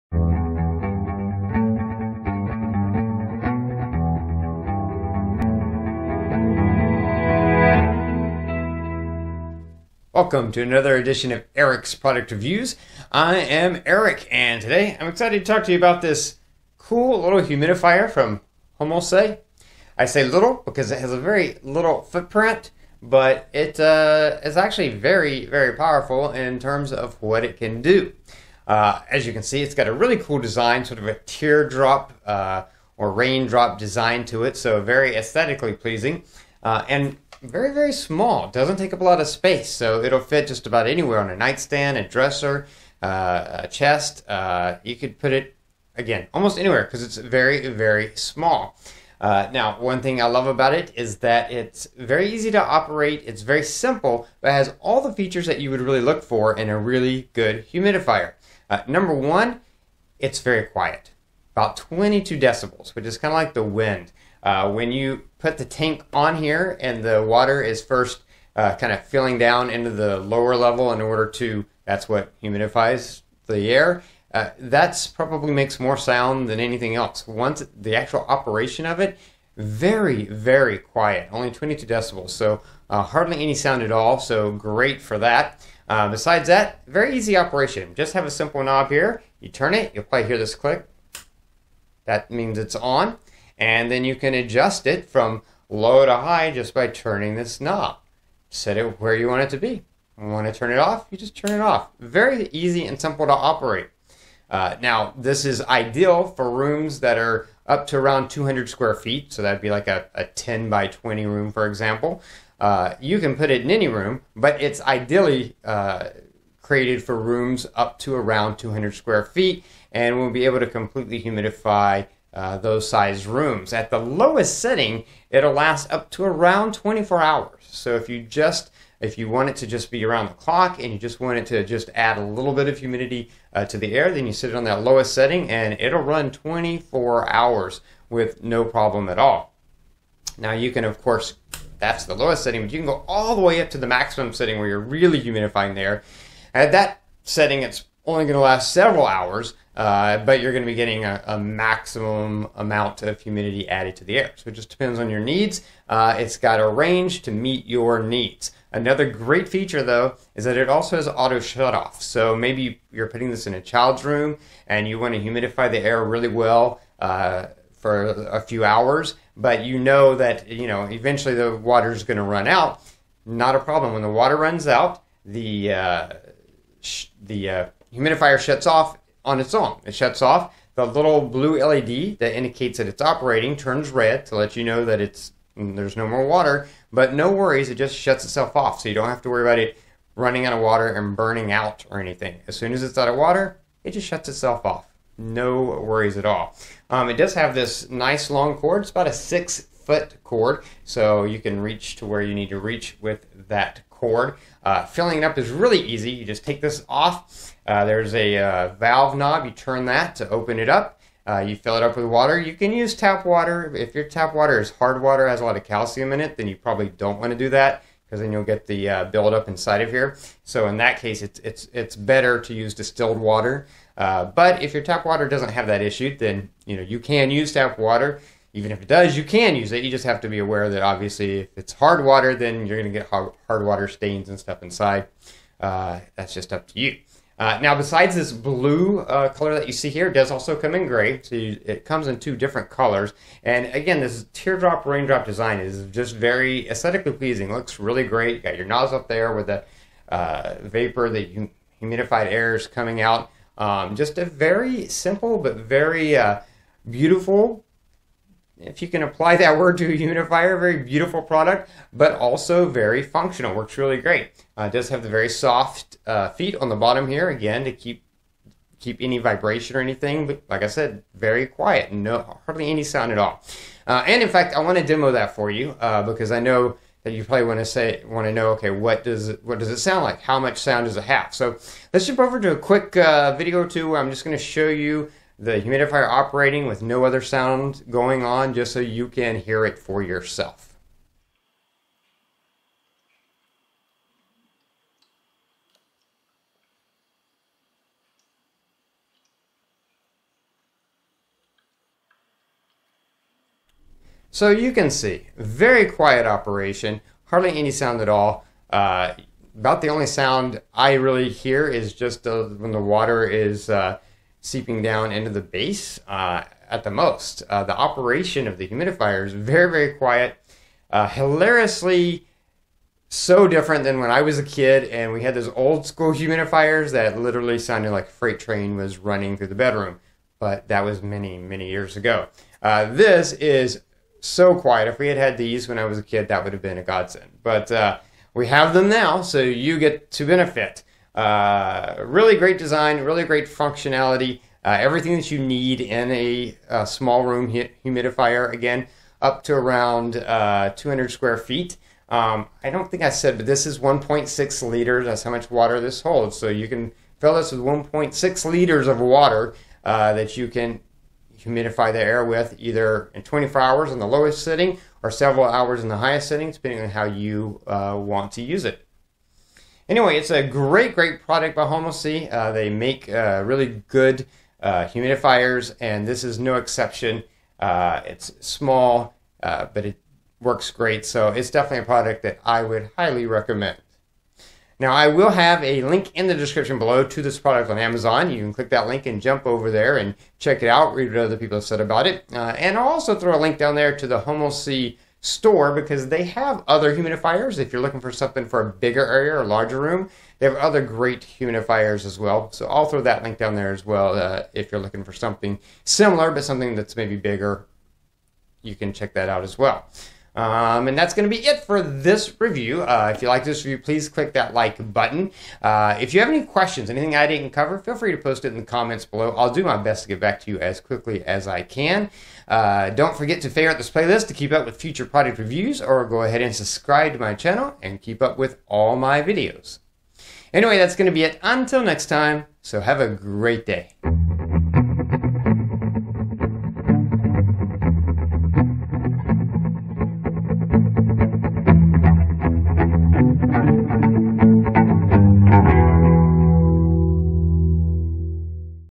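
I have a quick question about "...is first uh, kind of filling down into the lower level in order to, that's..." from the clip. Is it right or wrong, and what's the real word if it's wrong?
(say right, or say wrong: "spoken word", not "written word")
right.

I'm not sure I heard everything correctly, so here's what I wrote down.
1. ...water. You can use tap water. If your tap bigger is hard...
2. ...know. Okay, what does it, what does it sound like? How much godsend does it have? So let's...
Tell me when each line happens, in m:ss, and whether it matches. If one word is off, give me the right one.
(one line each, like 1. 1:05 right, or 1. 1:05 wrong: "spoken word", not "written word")
1. 3:32 wrong: "water", not "bigger"
2. 4:38 wrong: "sound", not "godsend".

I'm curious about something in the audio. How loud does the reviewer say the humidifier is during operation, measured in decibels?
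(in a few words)
22 decibels.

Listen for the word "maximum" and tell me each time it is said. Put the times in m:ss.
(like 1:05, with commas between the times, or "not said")
2:23, 2:31.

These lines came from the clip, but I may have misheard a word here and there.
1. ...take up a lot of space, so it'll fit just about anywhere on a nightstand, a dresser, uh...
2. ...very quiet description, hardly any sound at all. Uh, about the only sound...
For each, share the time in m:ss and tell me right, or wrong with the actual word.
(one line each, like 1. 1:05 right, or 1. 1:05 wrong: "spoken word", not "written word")
1. 0:38 right
2. 5:05 wrong: "operation", not "description".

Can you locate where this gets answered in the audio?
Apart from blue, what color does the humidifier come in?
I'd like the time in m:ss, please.
4:00.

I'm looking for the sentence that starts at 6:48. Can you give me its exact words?
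You can check that out as well.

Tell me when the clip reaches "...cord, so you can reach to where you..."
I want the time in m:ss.
3:20.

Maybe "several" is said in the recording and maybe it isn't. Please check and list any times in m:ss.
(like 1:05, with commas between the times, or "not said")
2:28, 6:05.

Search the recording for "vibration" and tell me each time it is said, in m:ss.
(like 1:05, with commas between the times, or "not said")
4:29.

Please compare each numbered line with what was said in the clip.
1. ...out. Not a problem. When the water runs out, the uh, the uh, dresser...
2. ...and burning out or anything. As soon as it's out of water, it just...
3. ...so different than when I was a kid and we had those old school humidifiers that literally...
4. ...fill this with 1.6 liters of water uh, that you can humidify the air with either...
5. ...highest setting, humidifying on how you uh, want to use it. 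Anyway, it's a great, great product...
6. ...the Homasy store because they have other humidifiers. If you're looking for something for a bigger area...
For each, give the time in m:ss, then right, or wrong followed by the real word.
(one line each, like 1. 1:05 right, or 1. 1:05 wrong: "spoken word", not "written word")
1. 2:52 wrong: "humidifier", not "dresser"
2. 3:10 right
3. 5:23 right
4. 5:57 right
5. 6:05 wrong: "depending", not "humidifying"
6. 6:34 right.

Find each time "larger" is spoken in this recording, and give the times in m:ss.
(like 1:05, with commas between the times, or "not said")
6:39.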